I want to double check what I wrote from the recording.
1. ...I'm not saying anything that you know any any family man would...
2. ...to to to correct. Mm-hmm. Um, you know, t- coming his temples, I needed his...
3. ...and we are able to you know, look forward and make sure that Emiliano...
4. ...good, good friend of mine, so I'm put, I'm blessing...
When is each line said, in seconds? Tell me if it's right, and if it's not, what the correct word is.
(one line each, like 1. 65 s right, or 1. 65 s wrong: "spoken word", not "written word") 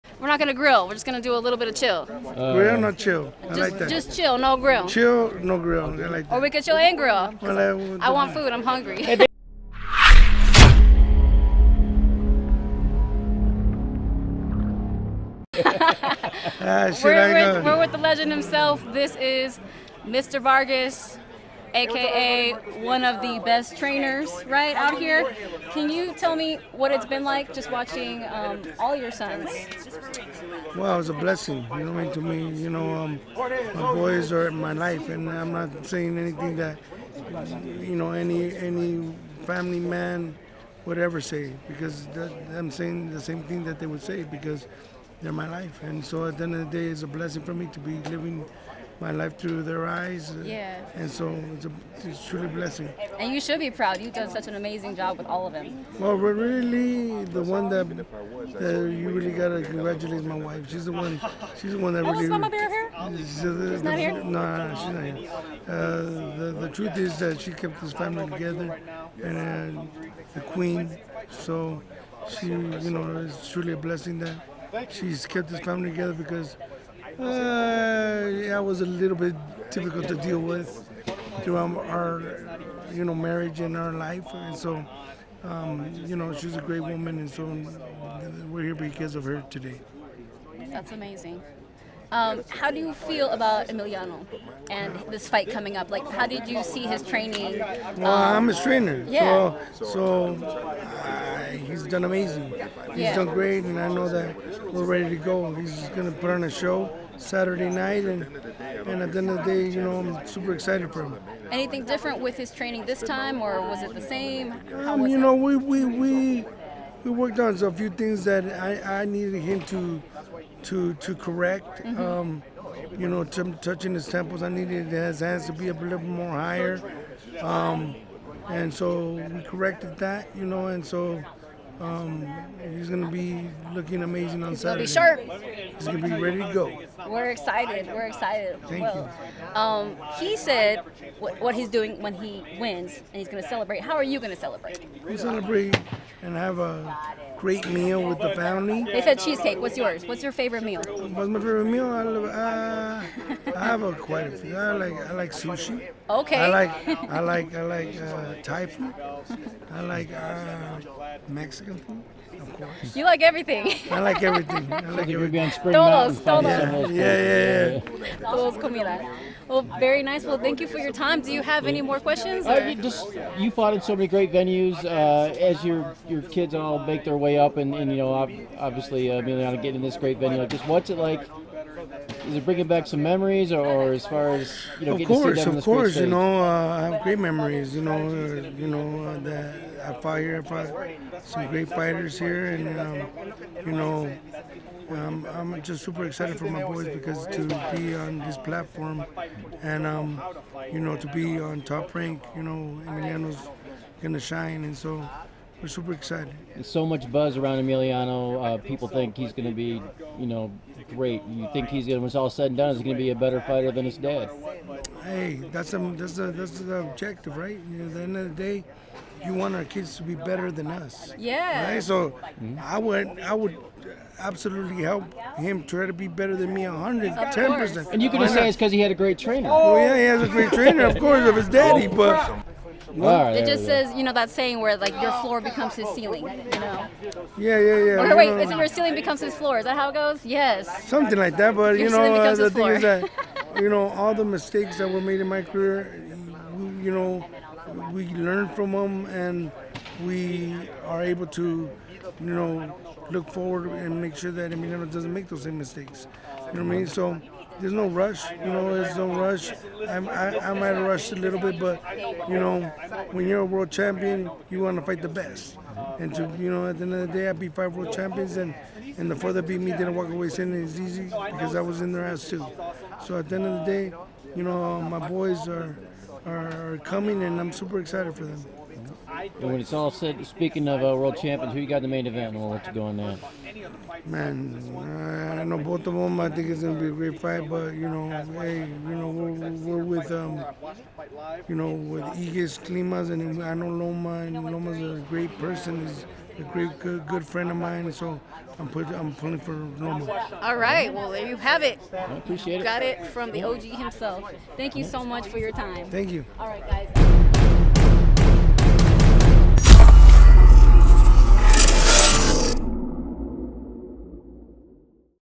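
1. 35 s right
2. 119 s wrong: "touching", not "coming"
3. 249 s right
4. 296 s wrong: "pulling", not "blessing".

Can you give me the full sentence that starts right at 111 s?
Anything different with his training this time, or was it the same?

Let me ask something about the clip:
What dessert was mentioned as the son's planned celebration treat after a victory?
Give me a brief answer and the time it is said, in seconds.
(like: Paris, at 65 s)
Cheesecake, at 149 s.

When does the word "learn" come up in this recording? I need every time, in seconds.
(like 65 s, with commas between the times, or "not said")
248 s.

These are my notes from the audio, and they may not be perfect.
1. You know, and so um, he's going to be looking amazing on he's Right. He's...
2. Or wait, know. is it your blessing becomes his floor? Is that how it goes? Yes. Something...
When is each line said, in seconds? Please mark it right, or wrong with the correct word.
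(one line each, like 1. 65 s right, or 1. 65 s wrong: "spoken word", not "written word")
1. 130 s wrong: "Saturday", not "Right"
2. 237 s wrong: "ceiling", not "blessing".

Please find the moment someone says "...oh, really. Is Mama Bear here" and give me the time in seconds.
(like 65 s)
62 s.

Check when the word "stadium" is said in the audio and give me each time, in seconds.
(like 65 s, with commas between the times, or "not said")
not said.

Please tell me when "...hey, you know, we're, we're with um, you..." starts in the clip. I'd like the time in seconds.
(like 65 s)
288 s.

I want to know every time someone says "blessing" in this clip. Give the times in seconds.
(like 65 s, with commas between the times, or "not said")
31 s, 47 s, 52 s, 73 s.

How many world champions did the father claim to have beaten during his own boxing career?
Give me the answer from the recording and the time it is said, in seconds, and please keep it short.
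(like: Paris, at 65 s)
5, at 267 s.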